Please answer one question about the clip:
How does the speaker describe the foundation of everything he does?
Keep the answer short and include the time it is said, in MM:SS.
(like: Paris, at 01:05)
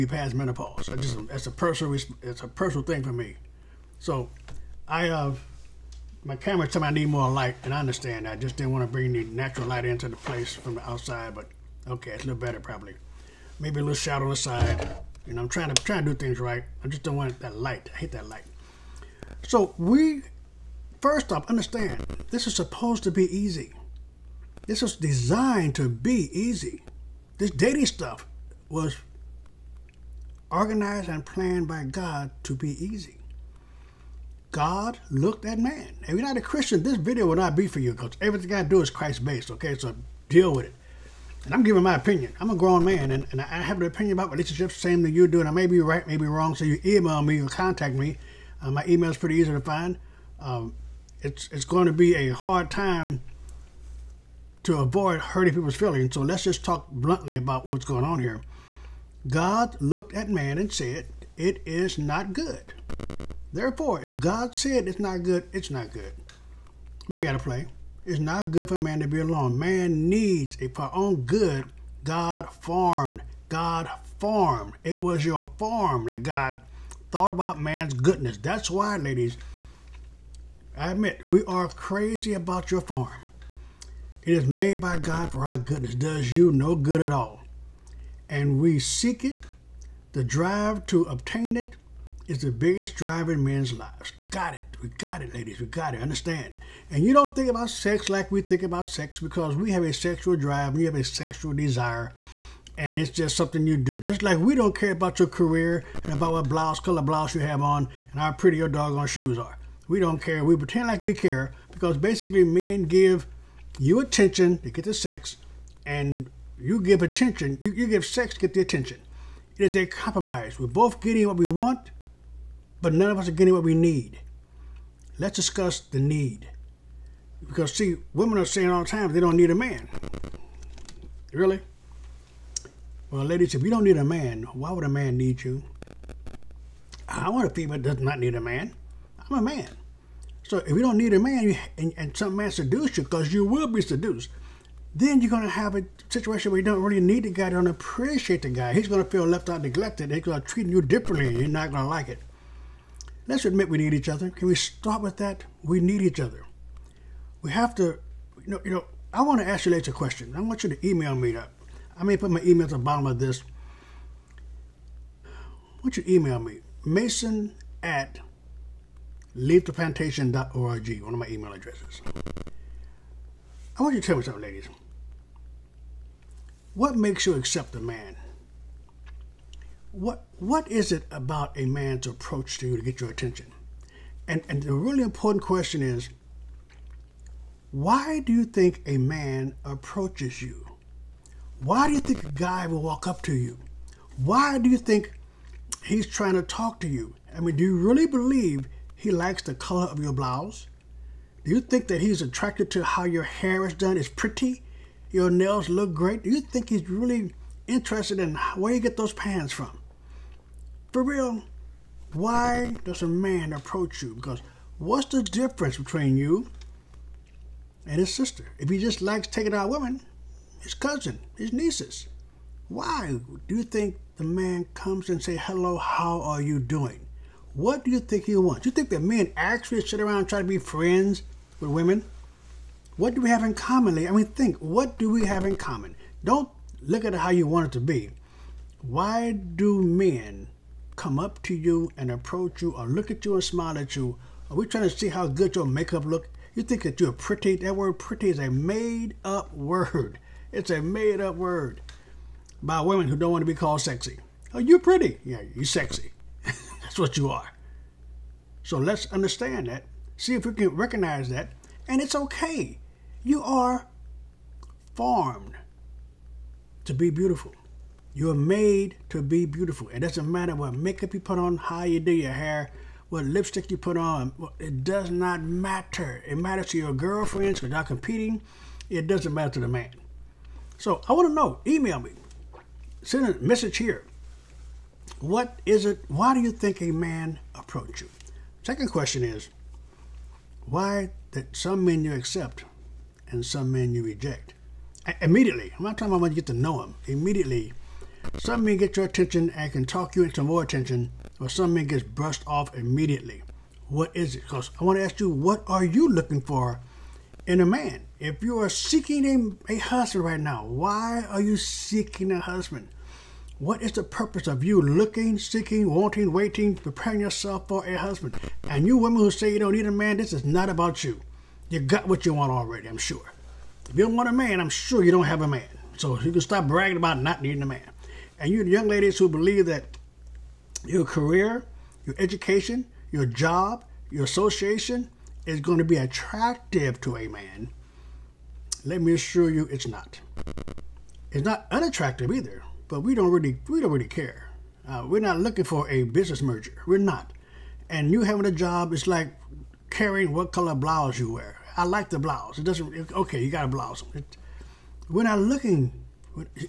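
Christ based, at 00:38.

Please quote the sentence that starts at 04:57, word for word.
Immediately, some men get your attention and can talk you into more attention, while some men gets brushed off immediately.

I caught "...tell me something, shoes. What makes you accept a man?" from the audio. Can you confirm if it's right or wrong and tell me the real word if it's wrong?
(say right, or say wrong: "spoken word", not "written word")
wrong: "ladies", not "shoes".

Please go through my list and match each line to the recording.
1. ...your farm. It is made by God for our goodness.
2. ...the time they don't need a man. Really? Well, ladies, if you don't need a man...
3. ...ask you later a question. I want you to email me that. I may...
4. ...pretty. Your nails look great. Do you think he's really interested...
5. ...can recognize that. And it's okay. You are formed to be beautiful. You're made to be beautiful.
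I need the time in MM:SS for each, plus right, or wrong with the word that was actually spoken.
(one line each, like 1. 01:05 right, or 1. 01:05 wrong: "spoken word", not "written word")
1. 01:22 right
2. 02:08 right
3. 02:39 right
4. 03:24 right
5. 04:20 right.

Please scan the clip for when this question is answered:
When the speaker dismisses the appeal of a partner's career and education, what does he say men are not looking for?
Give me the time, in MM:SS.
05:46.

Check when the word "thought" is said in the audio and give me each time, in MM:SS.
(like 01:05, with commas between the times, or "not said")
01:17.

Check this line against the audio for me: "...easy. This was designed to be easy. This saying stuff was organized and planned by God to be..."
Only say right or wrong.
wrong.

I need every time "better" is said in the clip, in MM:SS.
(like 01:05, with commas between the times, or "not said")
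00:12.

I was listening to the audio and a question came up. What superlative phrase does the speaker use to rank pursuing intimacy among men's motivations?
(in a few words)
the biggest drive.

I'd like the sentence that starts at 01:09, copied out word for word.
Man needs, a for own good, God formed.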